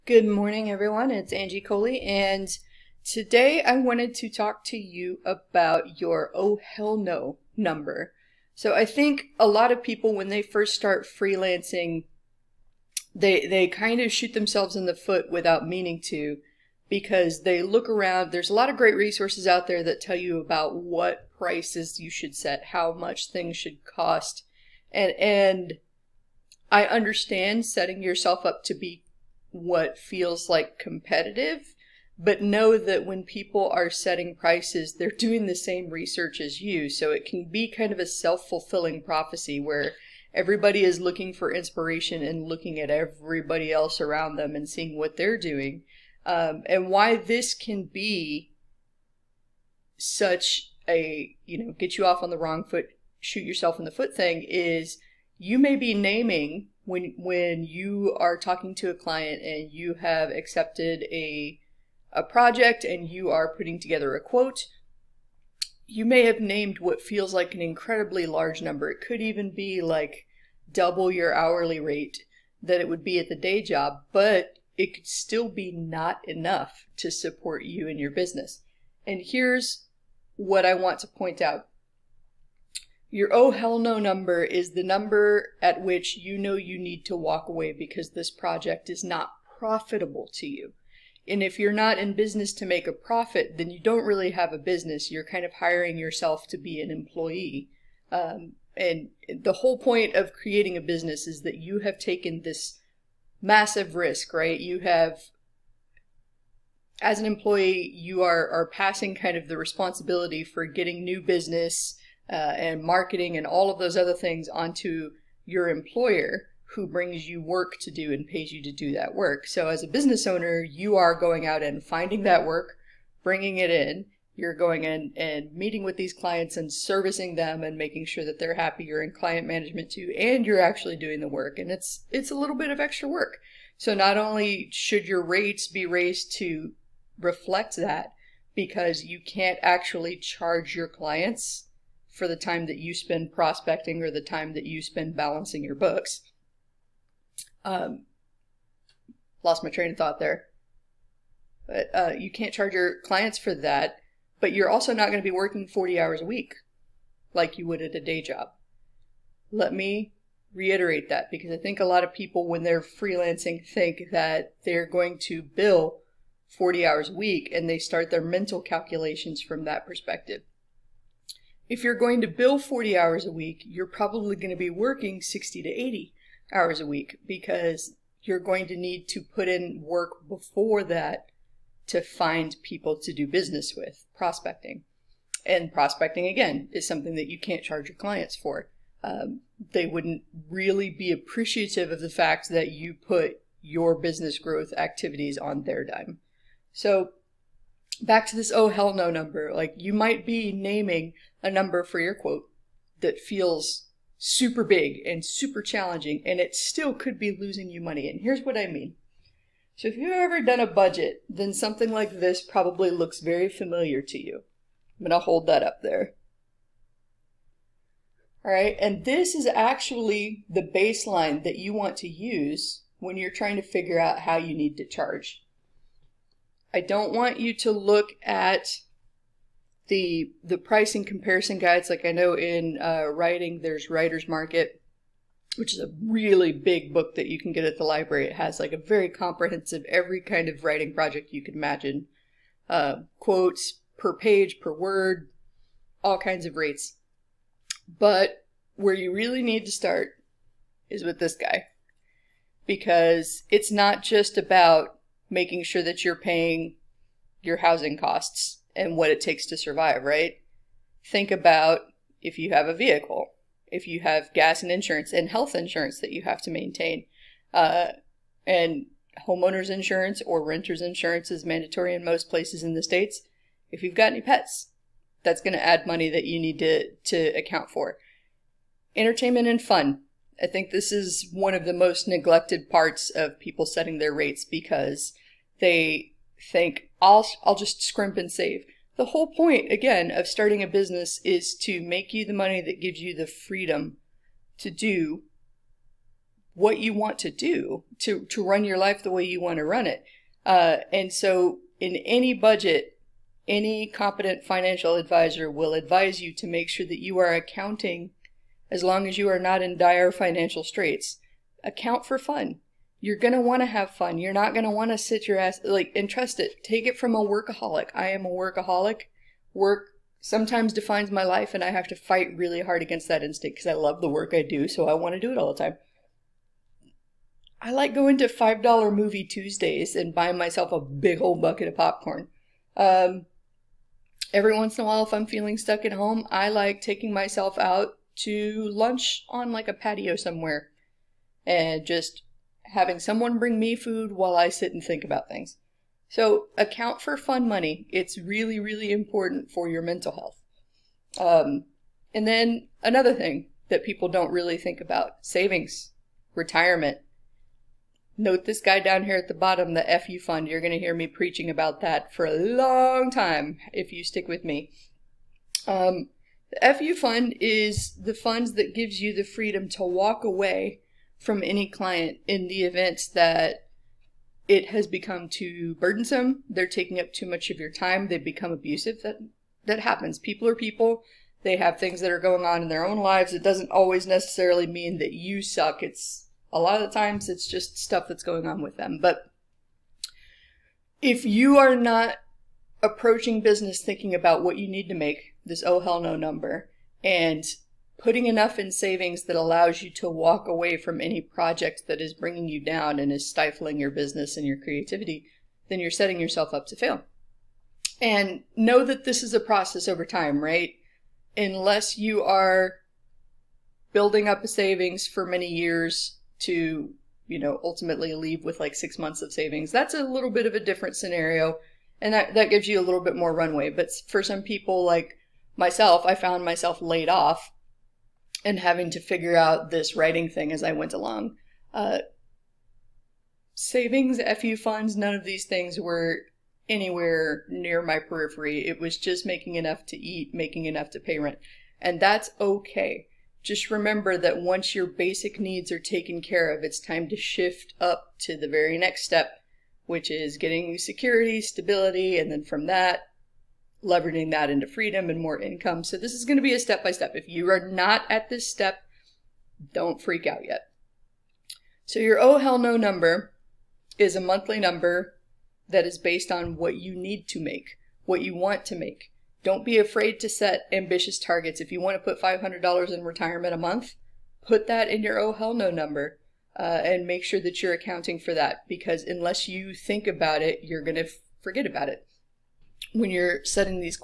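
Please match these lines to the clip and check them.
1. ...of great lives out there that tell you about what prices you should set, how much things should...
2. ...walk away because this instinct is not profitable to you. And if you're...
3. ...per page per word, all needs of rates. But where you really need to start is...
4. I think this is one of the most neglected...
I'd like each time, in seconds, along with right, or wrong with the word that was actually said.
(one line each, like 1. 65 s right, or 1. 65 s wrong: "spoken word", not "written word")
1. 18 s wrong: "resources", not "lives"
2. 87 s wrong: "project", not "instinct"
3. 243 s wrong: "kinds", not "needs"
4. 280 s right.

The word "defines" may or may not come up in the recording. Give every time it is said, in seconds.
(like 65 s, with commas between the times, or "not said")
320 s.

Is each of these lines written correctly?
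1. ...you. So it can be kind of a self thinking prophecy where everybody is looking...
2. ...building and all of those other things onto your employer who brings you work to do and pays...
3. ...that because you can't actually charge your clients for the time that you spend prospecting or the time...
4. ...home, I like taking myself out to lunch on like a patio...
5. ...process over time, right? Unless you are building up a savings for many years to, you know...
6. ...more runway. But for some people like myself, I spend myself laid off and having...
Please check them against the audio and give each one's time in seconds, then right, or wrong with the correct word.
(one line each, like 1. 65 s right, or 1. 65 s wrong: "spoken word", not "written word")
1. 36 s wrong: "fulfilling", not "thinking"
2. 112 s wrong: "marketing", not "building"
3. 137 s right
4. 335 s right
5. 409 s right
6. 423 s wrong: "found", not "spend".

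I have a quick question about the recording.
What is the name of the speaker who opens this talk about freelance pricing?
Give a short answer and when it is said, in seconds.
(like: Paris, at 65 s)
Angie Colee, at 1 s.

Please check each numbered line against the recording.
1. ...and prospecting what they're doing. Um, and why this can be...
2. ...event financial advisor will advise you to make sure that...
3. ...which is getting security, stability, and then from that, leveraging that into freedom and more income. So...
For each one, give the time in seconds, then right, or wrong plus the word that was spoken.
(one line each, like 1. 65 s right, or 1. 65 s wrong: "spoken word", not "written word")
1. 44 s wrong: "seeing", not "prospecting"
2. 303 s wrong: "competent", not "event"
3. 449 s right.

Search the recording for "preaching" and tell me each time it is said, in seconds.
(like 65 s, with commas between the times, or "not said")
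361 s.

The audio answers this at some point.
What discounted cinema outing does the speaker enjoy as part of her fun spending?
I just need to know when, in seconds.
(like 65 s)
328 s.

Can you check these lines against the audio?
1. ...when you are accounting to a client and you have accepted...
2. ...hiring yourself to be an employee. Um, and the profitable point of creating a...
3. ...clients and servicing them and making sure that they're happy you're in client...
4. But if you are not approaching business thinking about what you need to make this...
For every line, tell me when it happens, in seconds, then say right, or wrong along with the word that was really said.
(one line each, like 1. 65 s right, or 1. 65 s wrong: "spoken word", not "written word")
1. 57 s wrong: "talking", not "accounting"
2. 95 s wrong: "whole", not "profitable"
3. 126 s right
4. 389 s right.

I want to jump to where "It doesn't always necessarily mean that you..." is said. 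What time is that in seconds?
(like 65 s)
383 s.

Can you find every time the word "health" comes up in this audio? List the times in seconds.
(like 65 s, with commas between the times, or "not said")
265 s, 350 s.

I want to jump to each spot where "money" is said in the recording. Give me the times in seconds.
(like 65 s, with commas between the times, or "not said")
207 s, 275 s, 292 s, 347 s.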